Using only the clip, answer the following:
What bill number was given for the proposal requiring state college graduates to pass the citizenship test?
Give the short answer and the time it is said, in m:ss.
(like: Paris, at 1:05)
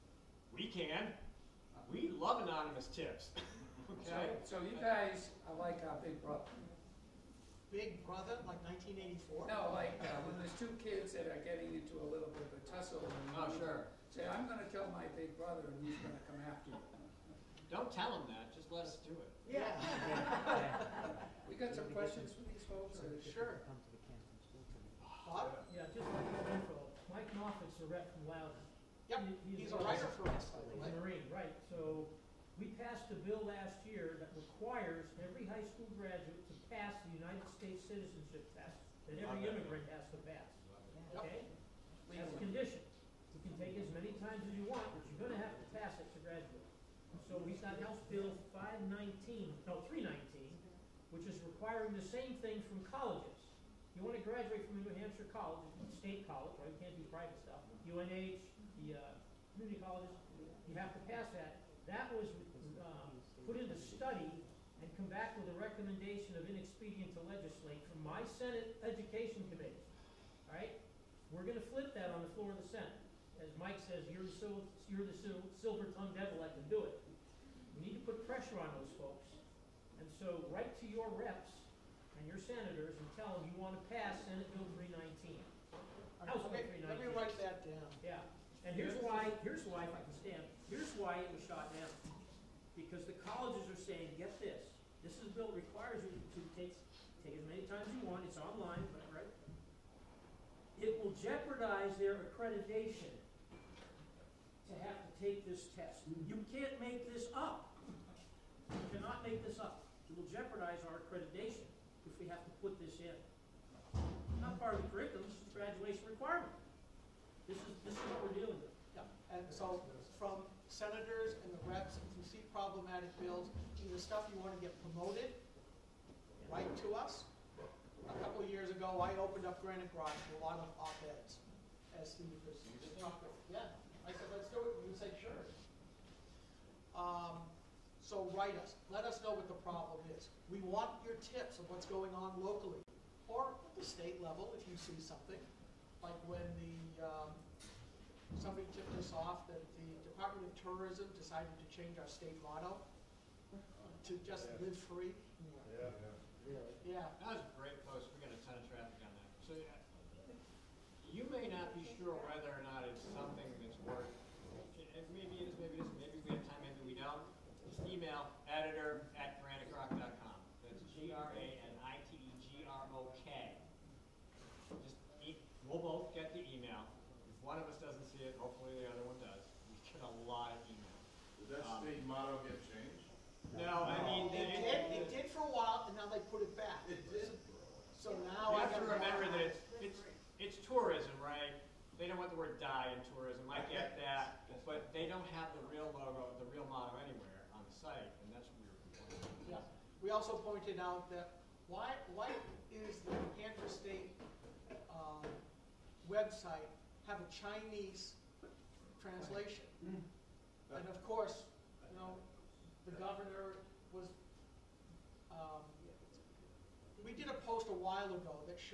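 319, at 0:49.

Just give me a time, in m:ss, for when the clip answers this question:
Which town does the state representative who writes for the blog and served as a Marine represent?
0:28.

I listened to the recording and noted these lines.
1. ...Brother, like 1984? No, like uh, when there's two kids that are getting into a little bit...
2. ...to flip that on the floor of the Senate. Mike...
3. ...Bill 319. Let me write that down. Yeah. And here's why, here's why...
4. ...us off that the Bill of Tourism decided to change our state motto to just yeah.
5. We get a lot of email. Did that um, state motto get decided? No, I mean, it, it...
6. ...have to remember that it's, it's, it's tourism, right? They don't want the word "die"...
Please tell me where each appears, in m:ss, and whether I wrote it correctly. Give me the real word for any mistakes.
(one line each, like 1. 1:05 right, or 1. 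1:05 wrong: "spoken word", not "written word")
1. 0:08 right
2. 1:11 right
3. 1:26 right
4. 2:29 wrong: "Department", not "Bill"
5. 2:59 wrong: "changed", not "decided"
6. 3:08 right.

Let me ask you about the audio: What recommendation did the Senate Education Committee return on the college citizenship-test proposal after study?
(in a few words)
Inexpedient to legislate.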